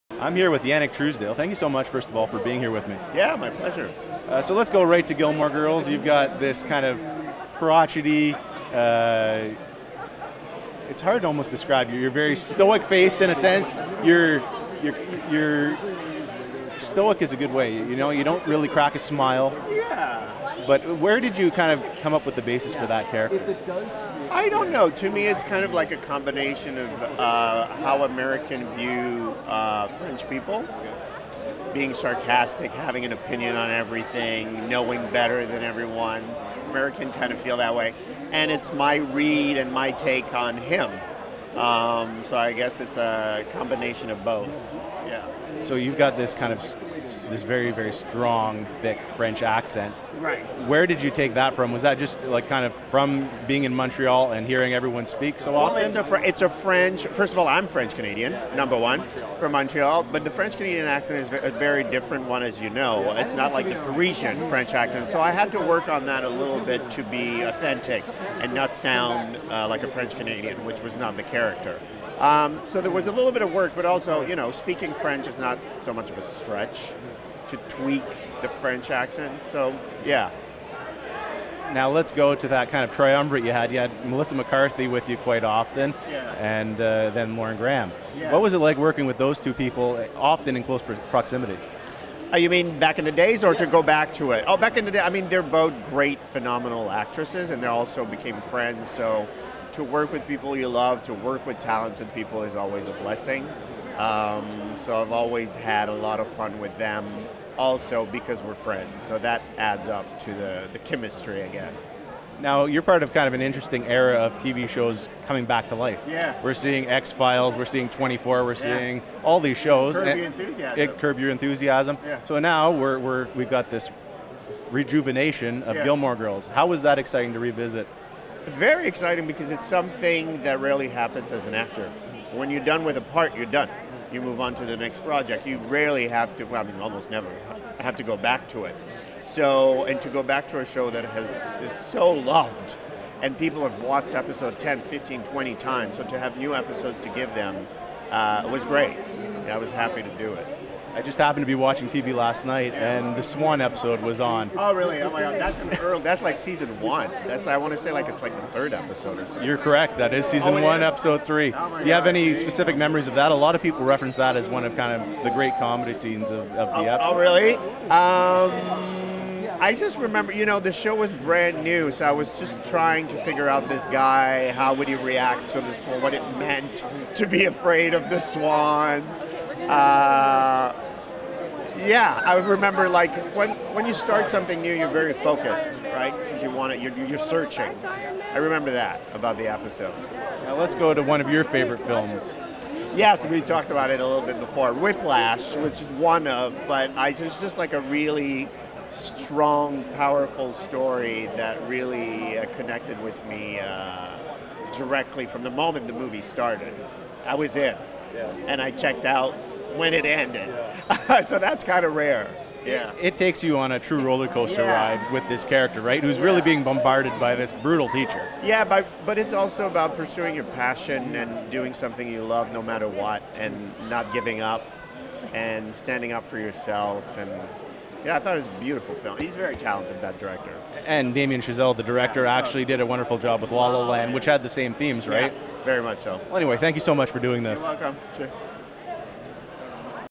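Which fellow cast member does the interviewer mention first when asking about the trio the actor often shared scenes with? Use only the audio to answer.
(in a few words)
Melissa McCarthy.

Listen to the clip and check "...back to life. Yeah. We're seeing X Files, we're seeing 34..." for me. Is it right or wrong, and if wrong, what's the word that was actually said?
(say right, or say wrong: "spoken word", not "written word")
wrong: "24", not "34".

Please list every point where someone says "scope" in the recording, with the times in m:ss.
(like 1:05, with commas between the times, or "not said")
not said.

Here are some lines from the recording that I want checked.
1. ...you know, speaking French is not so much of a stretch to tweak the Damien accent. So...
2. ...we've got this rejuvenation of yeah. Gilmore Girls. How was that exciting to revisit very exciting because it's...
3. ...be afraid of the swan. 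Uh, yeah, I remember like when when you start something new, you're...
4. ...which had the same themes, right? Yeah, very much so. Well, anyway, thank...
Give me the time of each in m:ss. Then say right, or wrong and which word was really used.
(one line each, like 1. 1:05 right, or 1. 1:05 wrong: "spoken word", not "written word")
1. 1:14 wrong: "French", not "Damien"
2. 2:03 right
3. 2:57 right
4. 3:54 right.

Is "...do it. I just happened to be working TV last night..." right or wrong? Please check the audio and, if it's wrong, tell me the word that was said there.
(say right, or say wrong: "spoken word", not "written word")
wrong: "watching", not "working".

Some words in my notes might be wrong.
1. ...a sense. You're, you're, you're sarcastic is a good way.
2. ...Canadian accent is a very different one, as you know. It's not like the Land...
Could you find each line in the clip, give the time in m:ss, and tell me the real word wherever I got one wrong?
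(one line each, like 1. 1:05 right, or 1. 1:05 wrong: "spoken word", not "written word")
1. 0:13 wrong: "stoic", not "sarcastic"
2. 1:00 wrong: "Parisian", not "Land".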